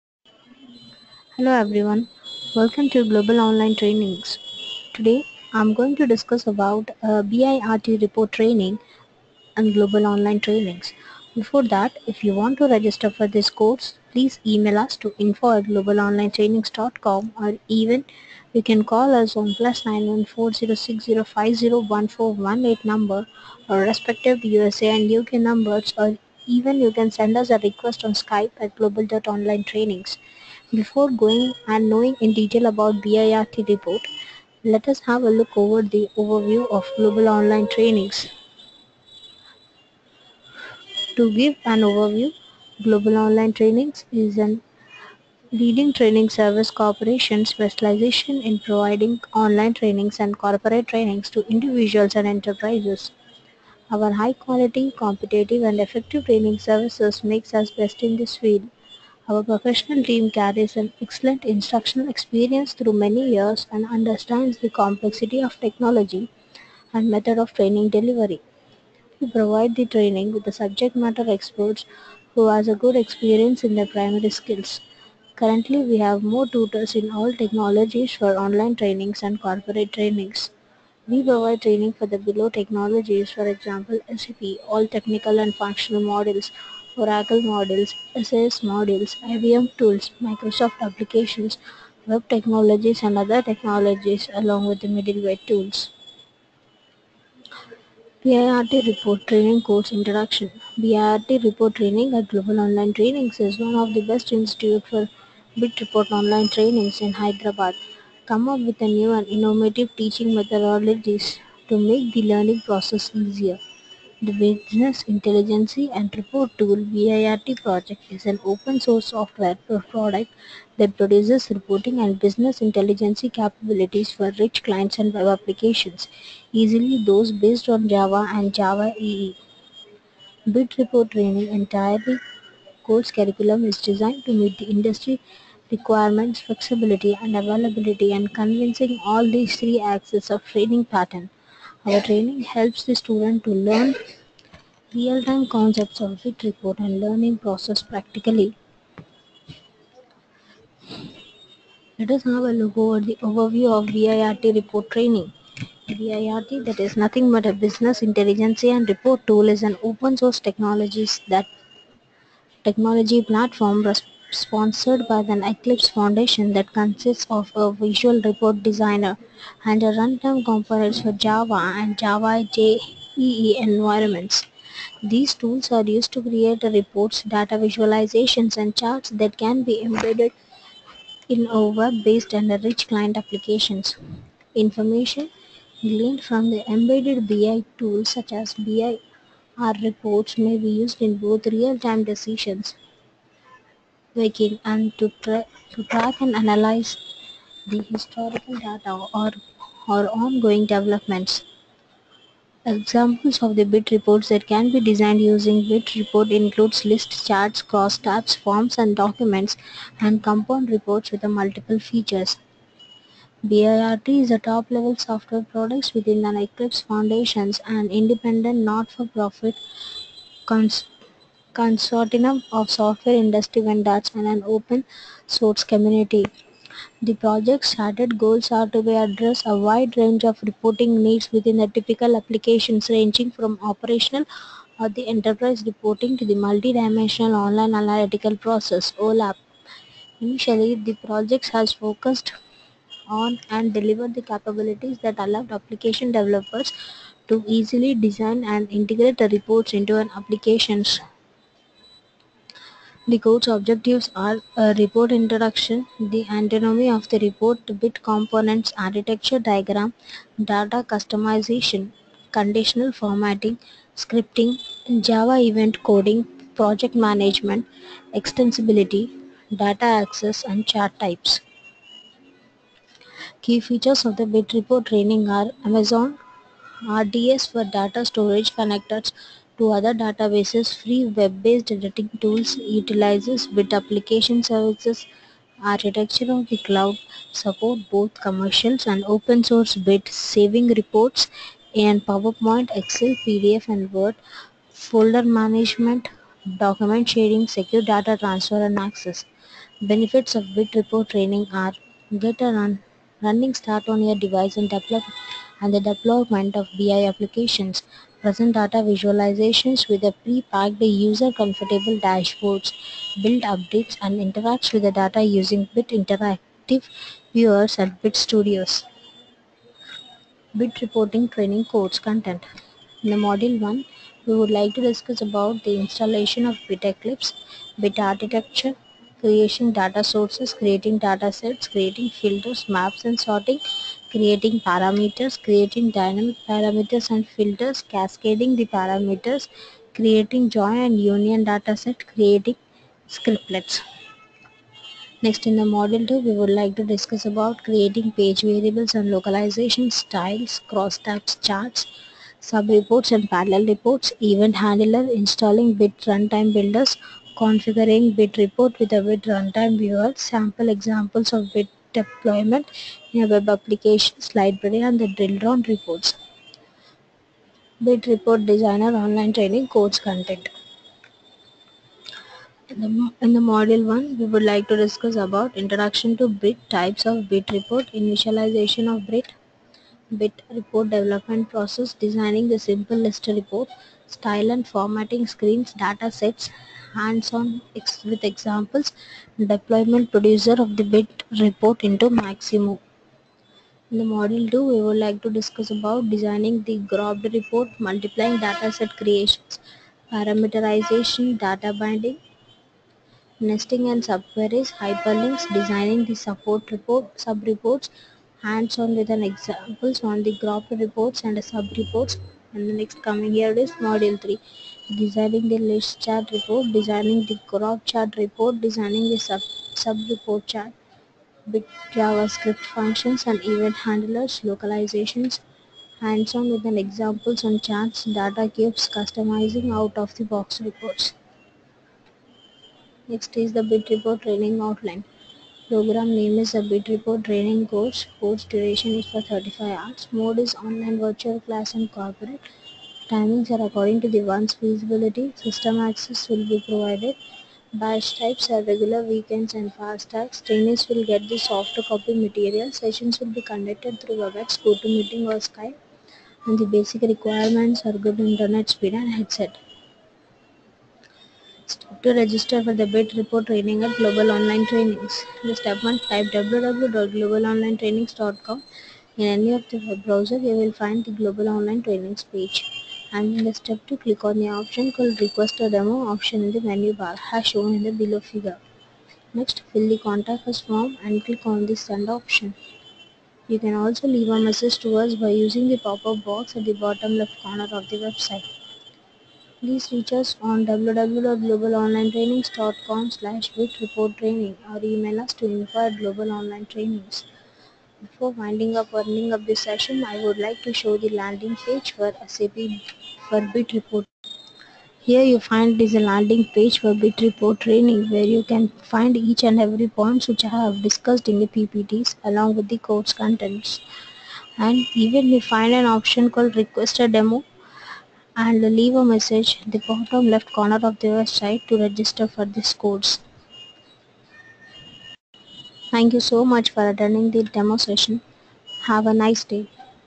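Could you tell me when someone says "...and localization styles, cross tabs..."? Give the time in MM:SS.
05:48.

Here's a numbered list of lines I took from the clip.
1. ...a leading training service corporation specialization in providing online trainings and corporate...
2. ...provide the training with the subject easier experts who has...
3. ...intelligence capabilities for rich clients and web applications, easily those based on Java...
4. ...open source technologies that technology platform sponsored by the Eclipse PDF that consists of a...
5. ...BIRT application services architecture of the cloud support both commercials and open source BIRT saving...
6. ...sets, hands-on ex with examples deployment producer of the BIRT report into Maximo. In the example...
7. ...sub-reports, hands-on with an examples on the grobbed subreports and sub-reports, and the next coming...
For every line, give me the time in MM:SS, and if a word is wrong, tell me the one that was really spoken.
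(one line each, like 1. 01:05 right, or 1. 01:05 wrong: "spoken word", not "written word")
1. 00:44 right
2. 01:09 wrong: "matter", not "easier"
3. 02:02 right
4. 02:39 wrong: "Foundation", not "PDF"
5. 04:43 right
6. 06:26 wrong: "module", not "example"
7. 06:47 wrong: "reports", not "subreports".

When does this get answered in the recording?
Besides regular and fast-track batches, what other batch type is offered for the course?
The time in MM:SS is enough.
07:29.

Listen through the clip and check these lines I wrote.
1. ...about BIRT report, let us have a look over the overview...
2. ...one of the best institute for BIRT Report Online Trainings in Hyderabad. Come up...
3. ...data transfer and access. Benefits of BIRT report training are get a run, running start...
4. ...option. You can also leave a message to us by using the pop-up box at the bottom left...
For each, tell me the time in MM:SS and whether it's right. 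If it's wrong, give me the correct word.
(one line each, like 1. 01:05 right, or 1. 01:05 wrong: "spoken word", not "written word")
1. 00:32 right
2. 01:43 right
3. 04:57 right
4. 08:02 right.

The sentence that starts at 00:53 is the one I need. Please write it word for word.
Our high quality, competitive and effective training services makes us best in this field.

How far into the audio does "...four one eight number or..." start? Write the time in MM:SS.
00:22.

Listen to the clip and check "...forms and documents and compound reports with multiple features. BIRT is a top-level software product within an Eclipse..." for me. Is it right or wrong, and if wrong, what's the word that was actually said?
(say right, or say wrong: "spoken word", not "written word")
right.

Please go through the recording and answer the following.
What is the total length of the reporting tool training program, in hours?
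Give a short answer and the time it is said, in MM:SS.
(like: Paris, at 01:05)
35, at 07:19.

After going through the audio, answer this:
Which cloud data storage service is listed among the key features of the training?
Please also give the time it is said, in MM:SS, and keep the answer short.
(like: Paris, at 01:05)
Amazon RDS, at 04:35.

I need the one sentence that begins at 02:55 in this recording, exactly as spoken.
These tools are used to create reports, data visualizations and charts that can be embedded in our web-based and rich client applications.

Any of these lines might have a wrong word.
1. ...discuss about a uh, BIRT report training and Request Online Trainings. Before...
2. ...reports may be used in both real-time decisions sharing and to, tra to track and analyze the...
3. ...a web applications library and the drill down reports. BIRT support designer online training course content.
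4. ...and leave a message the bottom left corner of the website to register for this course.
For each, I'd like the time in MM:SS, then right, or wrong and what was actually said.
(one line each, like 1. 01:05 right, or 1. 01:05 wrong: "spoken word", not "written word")
1. 00:06 wrong: "Global", not "Request"
2. 03:09 wrong: "making", not "sharing"
3. 06:03 wrong: "report", not "support"
4. 08:38 right.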